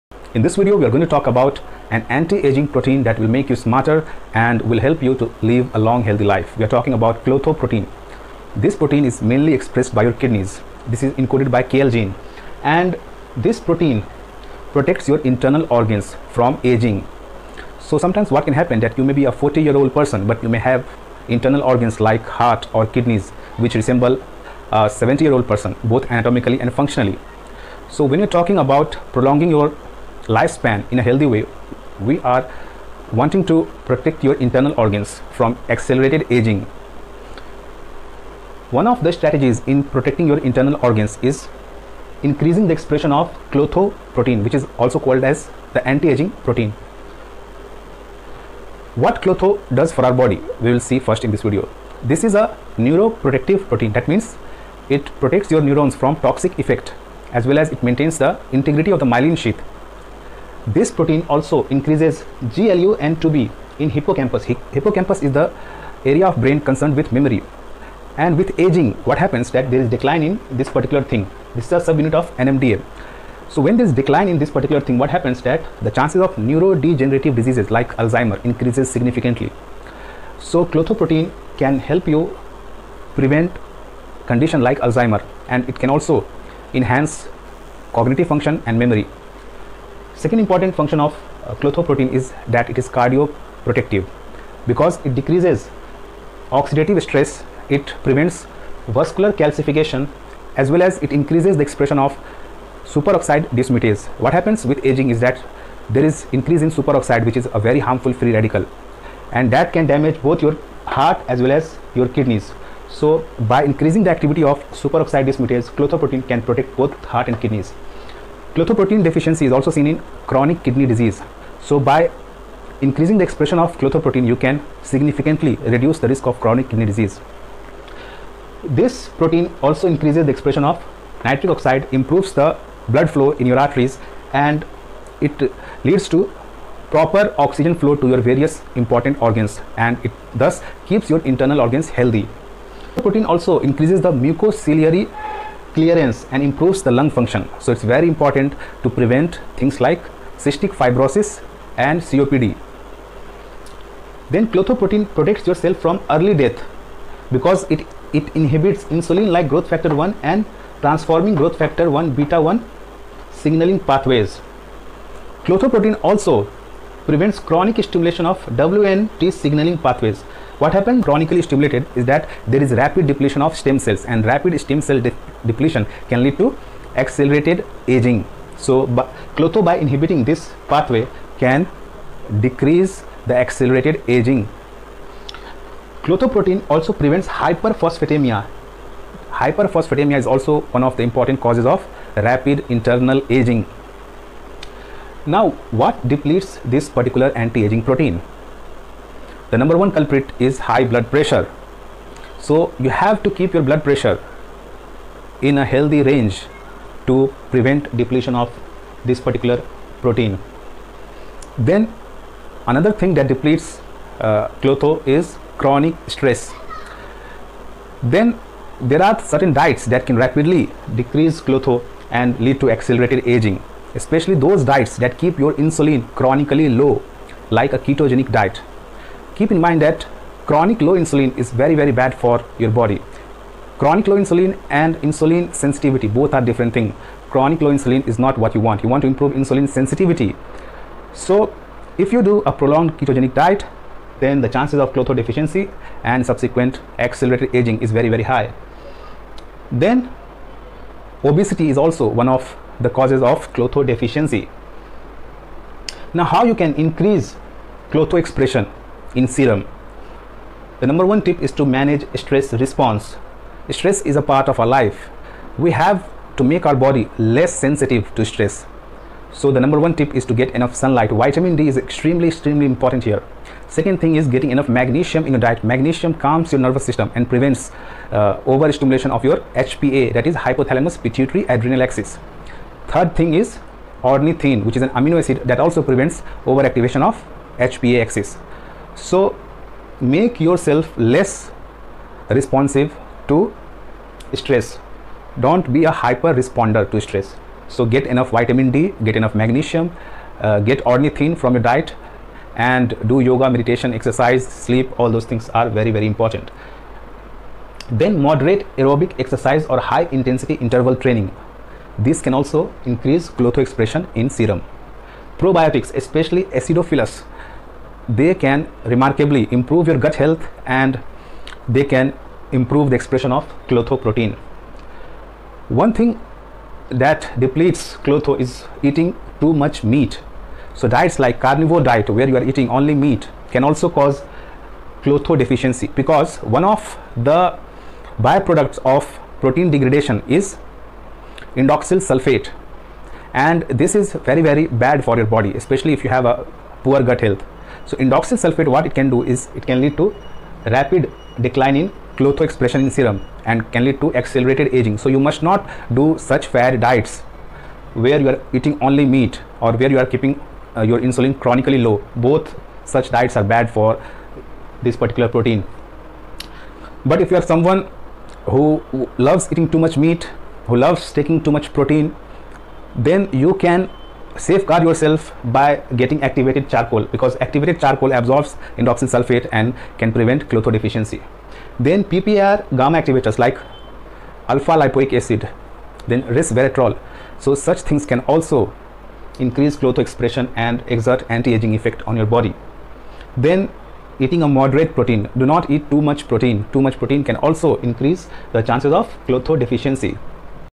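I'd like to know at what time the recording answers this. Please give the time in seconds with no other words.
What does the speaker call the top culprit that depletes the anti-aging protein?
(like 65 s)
200 s.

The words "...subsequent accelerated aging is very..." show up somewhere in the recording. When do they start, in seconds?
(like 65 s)
246 s.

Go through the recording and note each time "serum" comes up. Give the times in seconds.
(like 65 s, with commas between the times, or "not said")
259 s, 314 s, 352 s.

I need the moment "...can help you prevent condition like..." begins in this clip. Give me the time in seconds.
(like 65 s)
81 s.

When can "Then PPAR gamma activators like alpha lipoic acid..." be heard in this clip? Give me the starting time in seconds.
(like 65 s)
381 s.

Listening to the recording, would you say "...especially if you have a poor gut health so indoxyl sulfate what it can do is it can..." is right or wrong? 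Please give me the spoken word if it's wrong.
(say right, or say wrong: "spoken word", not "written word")
right.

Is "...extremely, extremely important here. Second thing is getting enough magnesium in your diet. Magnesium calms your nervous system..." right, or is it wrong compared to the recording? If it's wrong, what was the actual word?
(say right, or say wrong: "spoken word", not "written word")
right.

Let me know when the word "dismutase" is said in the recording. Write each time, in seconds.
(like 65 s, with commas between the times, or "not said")
103 s, 115 s.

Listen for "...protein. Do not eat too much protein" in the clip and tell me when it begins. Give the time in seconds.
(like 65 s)
394 s.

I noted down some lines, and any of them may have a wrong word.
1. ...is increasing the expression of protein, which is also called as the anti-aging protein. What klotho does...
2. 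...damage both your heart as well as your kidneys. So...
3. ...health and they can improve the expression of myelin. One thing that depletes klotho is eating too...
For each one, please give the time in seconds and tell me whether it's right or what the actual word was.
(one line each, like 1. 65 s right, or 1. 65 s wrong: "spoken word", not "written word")
1. 41 s right
2. 109 s right
3. 320 s wrong: "protein", not "myelin".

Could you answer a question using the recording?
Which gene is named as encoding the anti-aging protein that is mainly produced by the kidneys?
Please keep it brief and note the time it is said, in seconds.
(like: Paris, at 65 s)
KL gene, at 11 s.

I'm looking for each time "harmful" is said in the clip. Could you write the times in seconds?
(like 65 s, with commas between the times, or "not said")
107 s.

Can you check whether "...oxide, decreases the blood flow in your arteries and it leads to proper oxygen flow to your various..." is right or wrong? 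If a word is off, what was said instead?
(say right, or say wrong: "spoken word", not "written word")
wrong: "improves", not "decreases".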